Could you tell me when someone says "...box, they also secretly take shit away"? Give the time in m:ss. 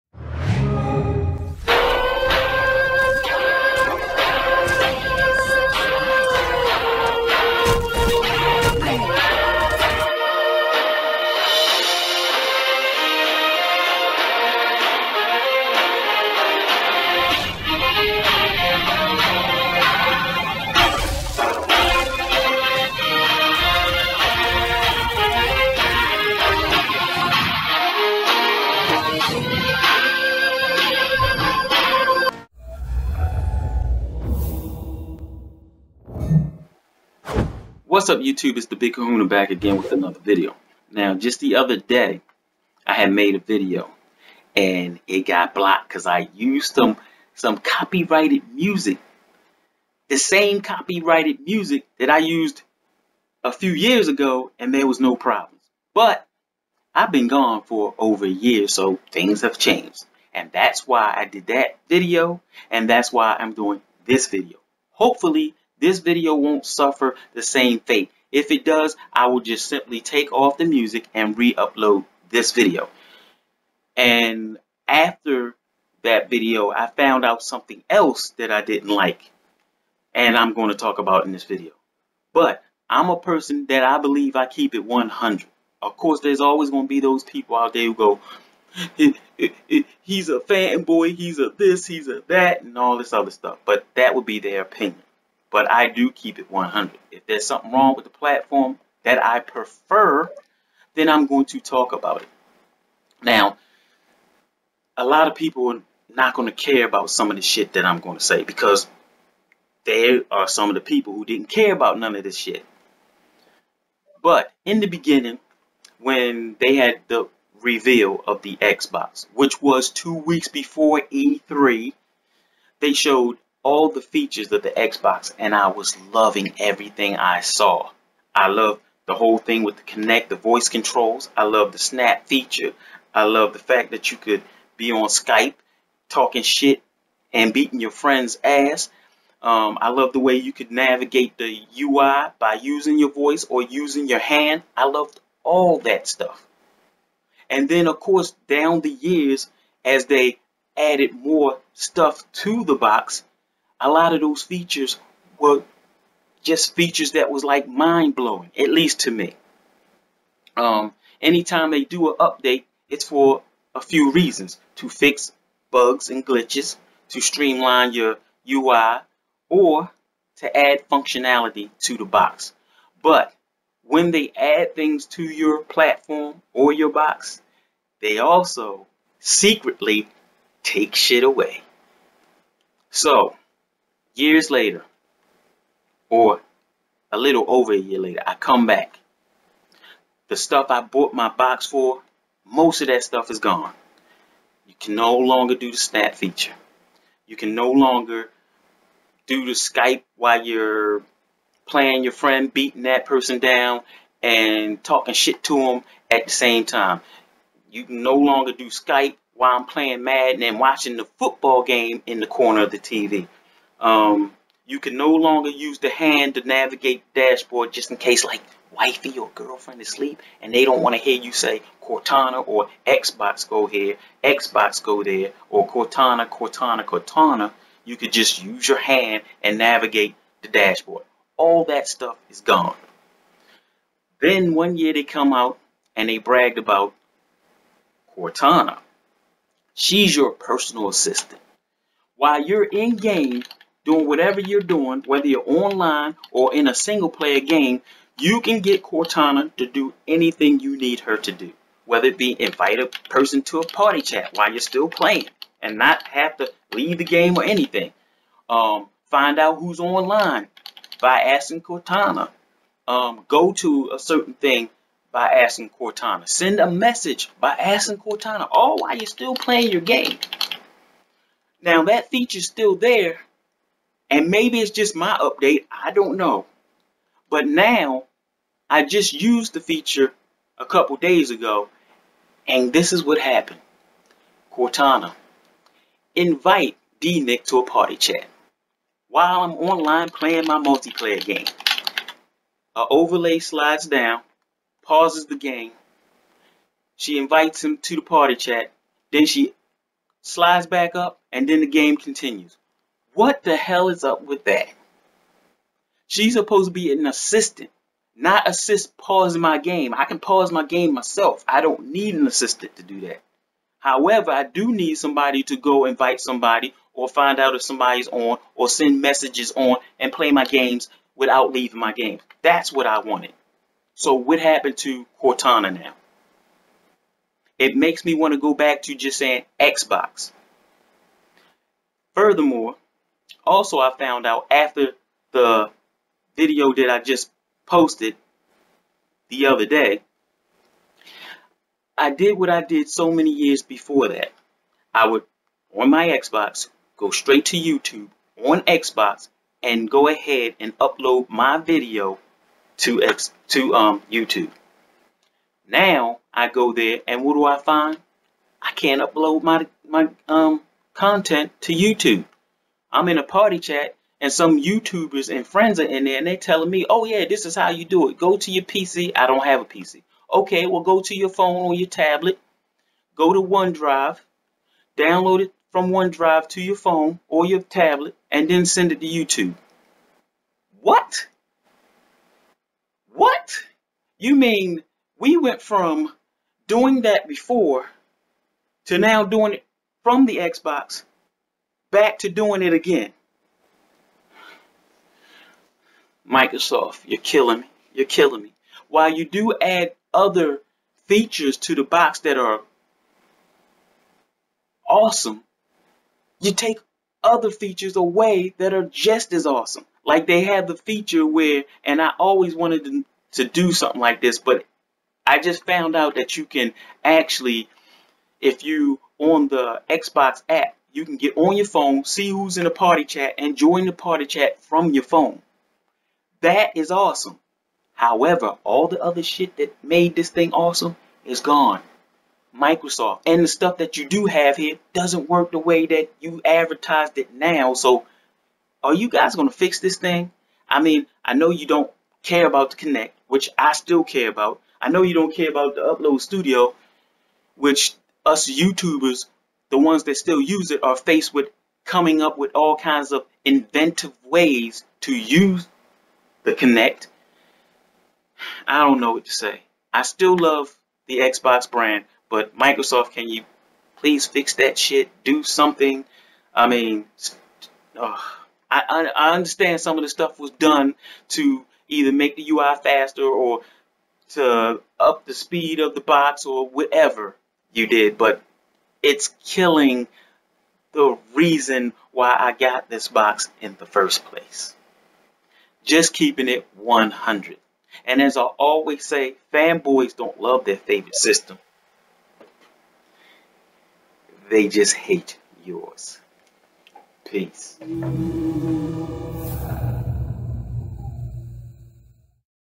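2:56.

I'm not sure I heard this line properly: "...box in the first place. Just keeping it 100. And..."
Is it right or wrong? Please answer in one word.
right.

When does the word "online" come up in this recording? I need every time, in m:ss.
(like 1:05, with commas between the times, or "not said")
4:05, 4:19, 4:49.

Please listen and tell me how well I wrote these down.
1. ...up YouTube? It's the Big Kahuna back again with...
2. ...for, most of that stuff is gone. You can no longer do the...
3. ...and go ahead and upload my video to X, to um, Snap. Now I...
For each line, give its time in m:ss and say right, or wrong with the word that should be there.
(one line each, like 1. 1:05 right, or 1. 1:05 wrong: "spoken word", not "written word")
1. 0:38 right
2. 3:11 right
3. 5:49 wrong: "YouTube", not "Snap".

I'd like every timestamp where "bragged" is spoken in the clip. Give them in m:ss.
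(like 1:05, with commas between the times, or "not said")
3:56.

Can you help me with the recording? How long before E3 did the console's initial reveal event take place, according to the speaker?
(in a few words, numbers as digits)
2 weeks.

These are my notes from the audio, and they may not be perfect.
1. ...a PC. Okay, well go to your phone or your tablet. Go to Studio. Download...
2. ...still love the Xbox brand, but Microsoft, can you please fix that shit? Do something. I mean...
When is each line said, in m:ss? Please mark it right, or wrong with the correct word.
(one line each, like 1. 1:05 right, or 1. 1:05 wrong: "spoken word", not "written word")
1. 6:09 wrong: "OneDrive", not "Studio"
2. 7:40 right.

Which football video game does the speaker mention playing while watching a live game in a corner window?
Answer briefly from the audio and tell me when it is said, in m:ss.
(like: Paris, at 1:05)
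Madden, at 3:30.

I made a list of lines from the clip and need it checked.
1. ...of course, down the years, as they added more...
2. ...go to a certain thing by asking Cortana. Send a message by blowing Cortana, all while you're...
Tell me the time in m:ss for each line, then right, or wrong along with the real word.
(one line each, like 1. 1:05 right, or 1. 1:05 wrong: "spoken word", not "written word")
1. 2:27 right
2. 4:23 wrong: "asking", not "blowing".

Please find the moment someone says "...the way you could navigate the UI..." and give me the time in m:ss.
2:20.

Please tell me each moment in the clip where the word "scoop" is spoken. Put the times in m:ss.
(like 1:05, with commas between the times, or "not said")
not said.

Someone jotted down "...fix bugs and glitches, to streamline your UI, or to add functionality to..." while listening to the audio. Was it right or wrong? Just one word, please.
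right.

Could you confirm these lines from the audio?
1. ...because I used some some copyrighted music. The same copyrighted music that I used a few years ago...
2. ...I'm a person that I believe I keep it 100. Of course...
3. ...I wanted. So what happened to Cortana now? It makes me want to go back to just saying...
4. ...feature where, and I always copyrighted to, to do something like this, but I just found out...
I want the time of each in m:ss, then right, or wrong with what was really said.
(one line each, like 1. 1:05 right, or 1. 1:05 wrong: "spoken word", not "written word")
1. 0:45 right
2. 1:22 right
3. 5:22 right
4. 6:50 wrong: "wanted", not "copyrighted".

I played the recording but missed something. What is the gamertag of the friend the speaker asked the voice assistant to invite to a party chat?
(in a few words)
D Nick.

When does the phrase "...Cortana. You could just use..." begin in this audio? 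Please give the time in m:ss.
3:46.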